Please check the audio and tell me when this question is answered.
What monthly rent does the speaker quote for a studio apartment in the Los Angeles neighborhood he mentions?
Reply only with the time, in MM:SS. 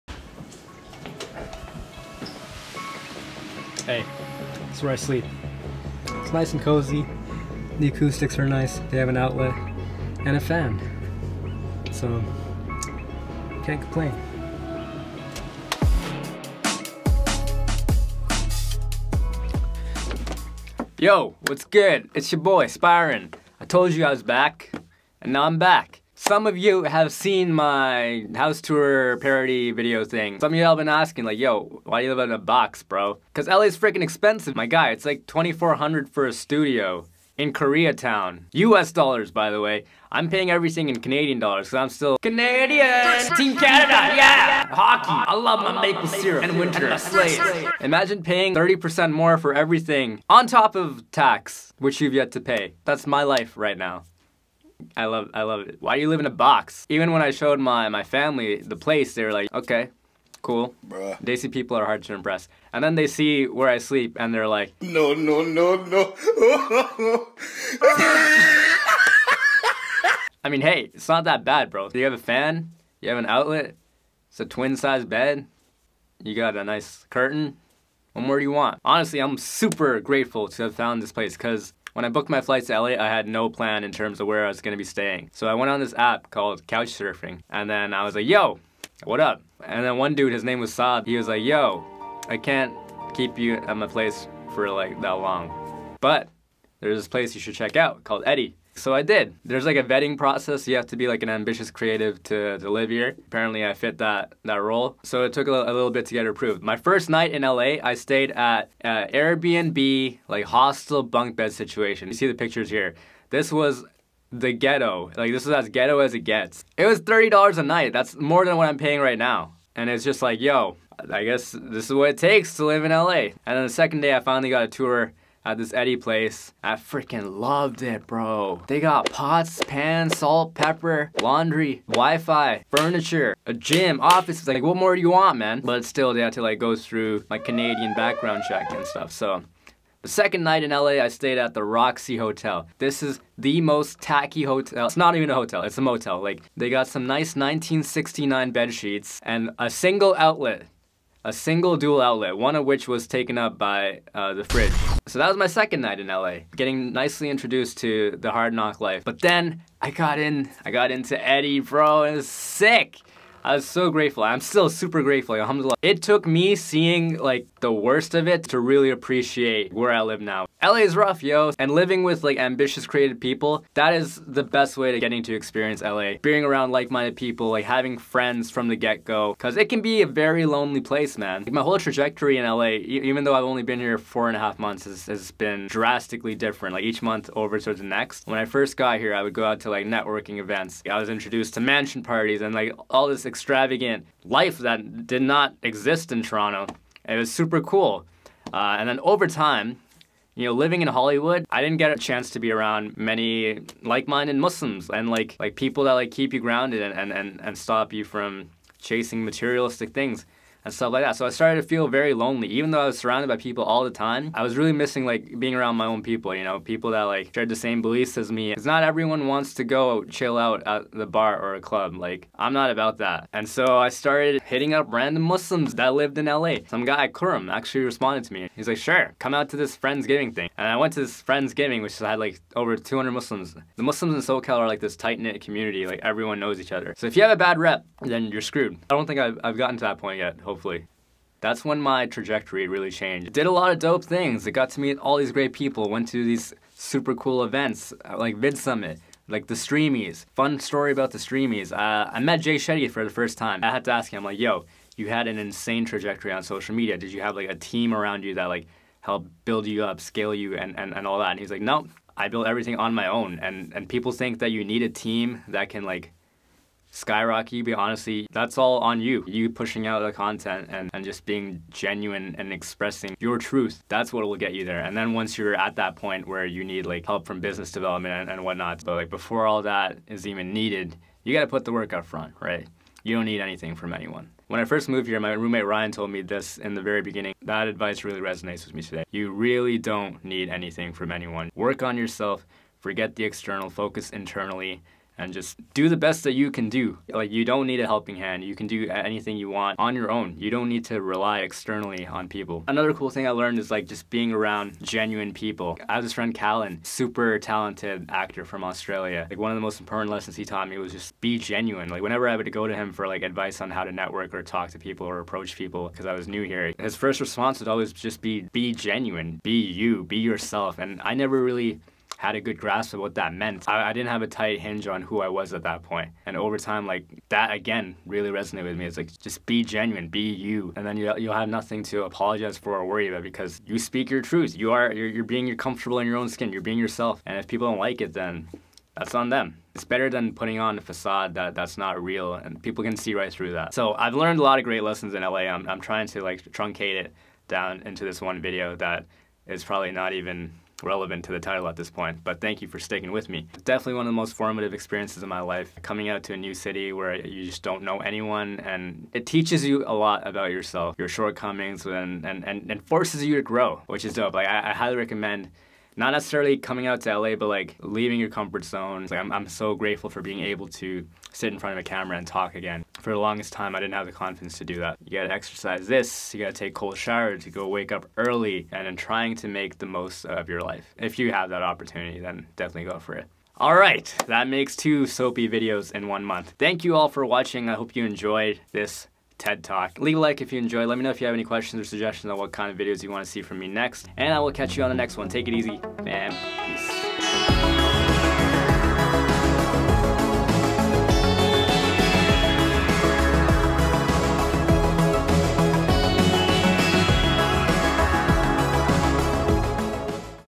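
00:35.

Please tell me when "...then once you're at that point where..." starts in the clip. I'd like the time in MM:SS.
04:34.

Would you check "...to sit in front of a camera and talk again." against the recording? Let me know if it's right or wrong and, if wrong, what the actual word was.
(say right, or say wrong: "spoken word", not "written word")
right.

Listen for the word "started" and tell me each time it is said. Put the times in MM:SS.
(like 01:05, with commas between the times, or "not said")
03:31, 03:43.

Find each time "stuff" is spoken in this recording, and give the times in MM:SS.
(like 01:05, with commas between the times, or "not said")
02:18, 03:30.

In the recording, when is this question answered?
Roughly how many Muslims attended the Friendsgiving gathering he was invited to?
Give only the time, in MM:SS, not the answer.
03:52.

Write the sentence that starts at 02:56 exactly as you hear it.
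Being around like-minded people, like having friends from the get-go, cause it can be a very lonely place, man.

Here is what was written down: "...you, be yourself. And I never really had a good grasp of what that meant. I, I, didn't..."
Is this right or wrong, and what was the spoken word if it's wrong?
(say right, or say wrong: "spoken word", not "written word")
right.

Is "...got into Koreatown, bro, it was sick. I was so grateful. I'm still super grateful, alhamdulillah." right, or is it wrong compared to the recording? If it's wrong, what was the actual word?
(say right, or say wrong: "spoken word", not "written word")
wrong: "Eddie", not "Koreatown".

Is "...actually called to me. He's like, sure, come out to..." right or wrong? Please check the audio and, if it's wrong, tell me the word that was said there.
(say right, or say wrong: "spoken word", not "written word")
wrong: "responded", not "called".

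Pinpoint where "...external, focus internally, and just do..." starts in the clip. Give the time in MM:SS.
04:53.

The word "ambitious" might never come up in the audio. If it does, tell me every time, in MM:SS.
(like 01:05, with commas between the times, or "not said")
01:41, 02:52.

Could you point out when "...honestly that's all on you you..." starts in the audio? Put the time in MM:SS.
04:27.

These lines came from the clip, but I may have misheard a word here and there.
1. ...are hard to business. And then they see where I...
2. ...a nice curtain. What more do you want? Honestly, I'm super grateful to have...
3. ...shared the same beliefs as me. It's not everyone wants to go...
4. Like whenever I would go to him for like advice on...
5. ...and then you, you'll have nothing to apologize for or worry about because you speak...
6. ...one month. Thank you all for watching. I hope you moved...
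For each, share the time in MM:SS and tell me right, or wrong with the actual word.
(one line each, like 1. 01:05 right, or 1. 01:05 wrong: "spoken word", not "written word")
1. 01:01 wrong: "impress", not "business"
2. 01:16 right
3. 03:37 right
4. 05:11 right
5. 05:30 right
6. 06:26 wrong: "enjoyed", not "moved".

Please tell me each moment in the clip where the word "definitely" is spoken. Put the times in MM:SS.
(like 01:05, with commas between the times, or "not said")
05:53, 06:22.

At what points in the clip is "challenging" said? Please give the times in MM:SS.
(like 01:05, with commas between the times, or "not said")
not said.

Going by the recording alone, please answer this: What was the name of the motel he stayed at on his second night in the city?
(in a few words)
Roxy Hotel.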